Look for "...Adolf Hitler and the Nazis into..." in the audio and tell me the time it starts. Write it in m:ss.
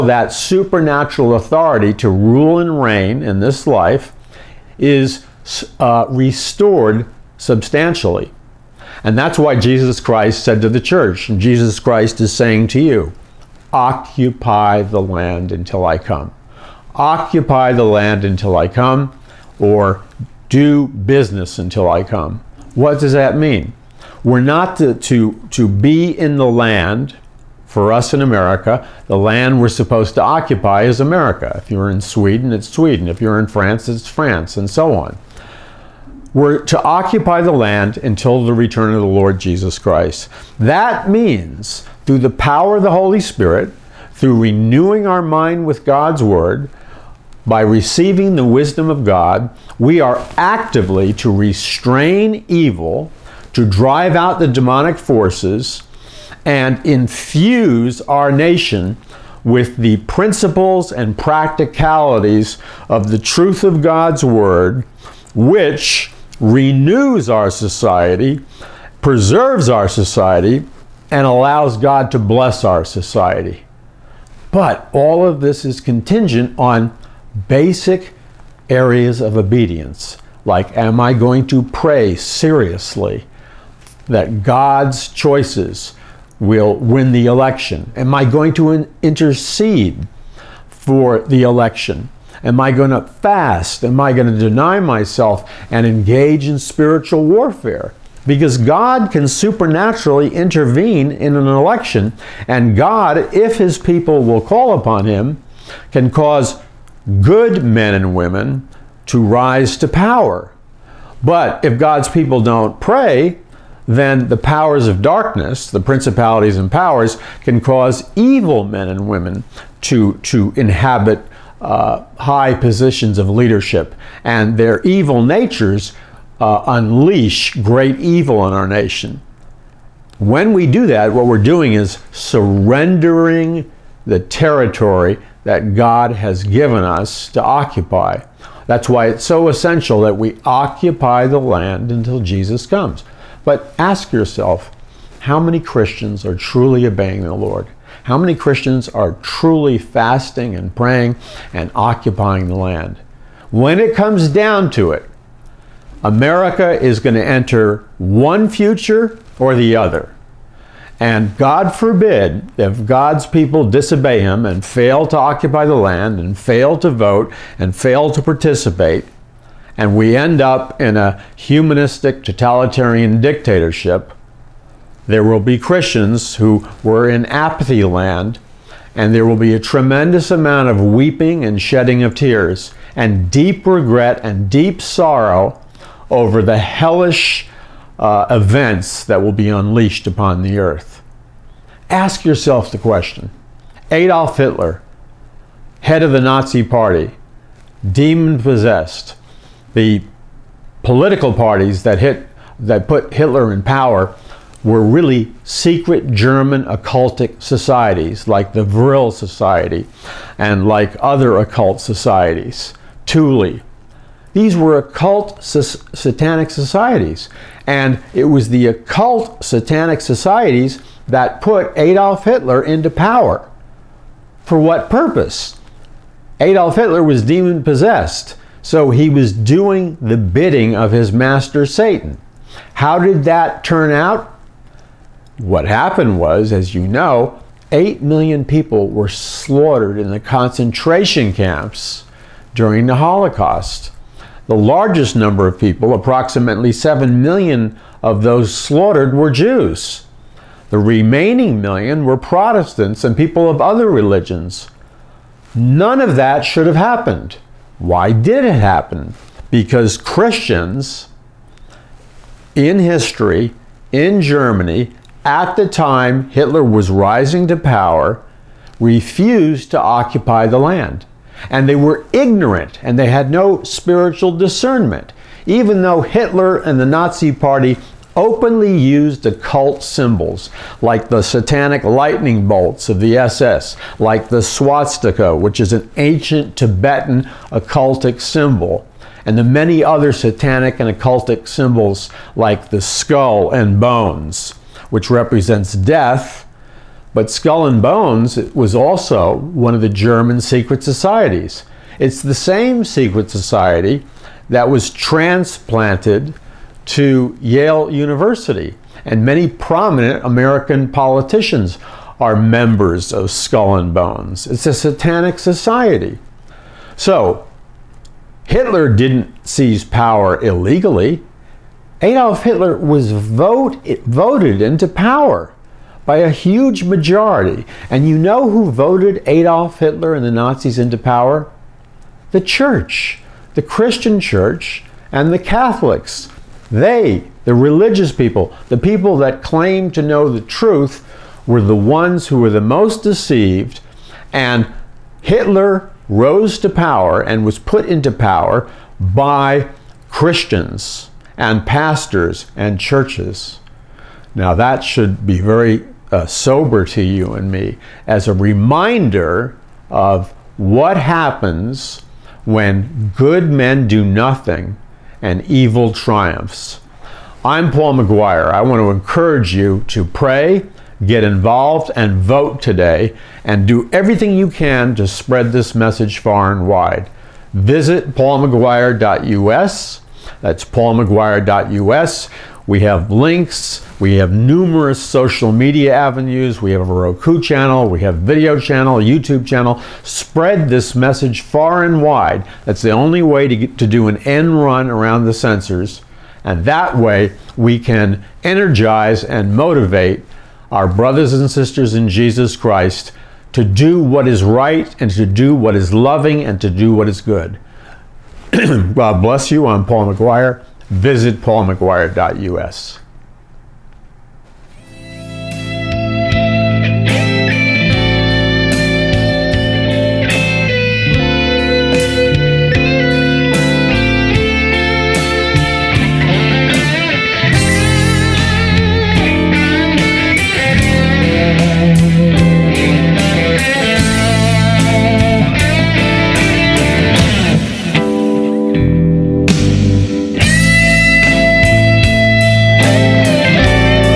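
5:29.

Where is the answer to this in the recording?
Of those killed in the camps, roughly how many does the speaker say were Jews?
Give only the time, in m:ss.
4:05.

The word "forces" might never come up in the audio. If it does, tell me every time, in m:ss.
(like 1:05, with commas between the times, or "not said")
0:54.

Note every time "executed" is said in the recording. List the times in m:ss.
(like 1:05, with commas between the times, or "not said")
not said.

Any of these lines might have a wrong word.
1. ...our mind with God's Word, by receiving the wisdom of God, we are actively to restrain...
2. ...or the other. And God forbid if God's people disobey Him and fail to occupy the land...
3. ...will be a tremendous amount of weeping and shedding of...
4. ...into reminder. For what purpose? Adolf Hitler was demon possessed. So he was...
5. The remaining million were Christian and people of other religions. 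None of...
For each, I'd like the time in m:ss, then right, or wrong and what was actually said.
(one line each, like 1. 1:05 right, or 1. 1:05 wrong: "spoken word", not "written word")
1. 0:45 right
2. 2:39 right
3. 2:59 right
4. 3:42 wrong: "power", not "reminder"
5. 4:10 wrong: "Protestants", not "Christian".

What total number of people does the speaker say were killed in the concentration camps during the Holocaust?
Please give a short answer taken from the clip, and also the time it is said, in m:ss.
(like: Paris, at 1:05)
8 million, at 3:57.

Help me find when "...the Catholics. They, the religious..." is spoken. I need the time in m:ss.
5:35.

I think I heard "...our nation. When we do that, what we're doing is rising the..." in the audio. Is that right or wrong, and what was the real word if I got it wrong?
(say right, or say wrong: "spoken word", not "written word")
wrong: "surrendering", not "rising".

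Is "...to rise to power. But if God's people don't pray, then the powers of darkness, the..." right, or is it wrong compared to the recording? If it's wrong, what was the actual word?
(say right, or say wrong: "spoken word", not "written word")
right.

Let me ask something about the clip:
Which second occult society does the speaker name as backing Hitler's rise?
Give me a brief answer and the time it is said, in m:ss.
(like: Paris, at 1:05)
Thule, at 3:33.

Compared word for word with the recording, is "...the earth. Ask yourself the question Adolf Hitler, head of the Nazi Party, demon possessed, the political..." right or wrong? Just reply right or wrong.
right.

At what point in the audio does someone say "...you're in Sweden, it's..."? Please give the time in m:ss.
0:31.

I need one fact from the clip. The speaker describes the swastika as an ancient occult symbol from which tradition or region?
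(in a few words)
Tibetan.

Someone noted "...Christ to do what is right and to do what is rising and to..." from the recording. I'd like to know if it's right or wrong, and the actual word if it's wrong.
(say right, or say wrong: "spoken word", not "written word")
wrong: "loving", not "rising".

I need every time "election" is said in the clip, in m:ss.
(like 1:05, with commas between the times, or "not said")
1:27, 1:31, 1:41.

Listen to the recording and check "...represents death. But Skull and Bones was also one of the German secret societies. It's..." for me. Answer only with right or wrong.
right.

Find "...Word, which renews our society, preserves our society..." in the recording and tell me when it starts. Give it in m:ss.
1:04.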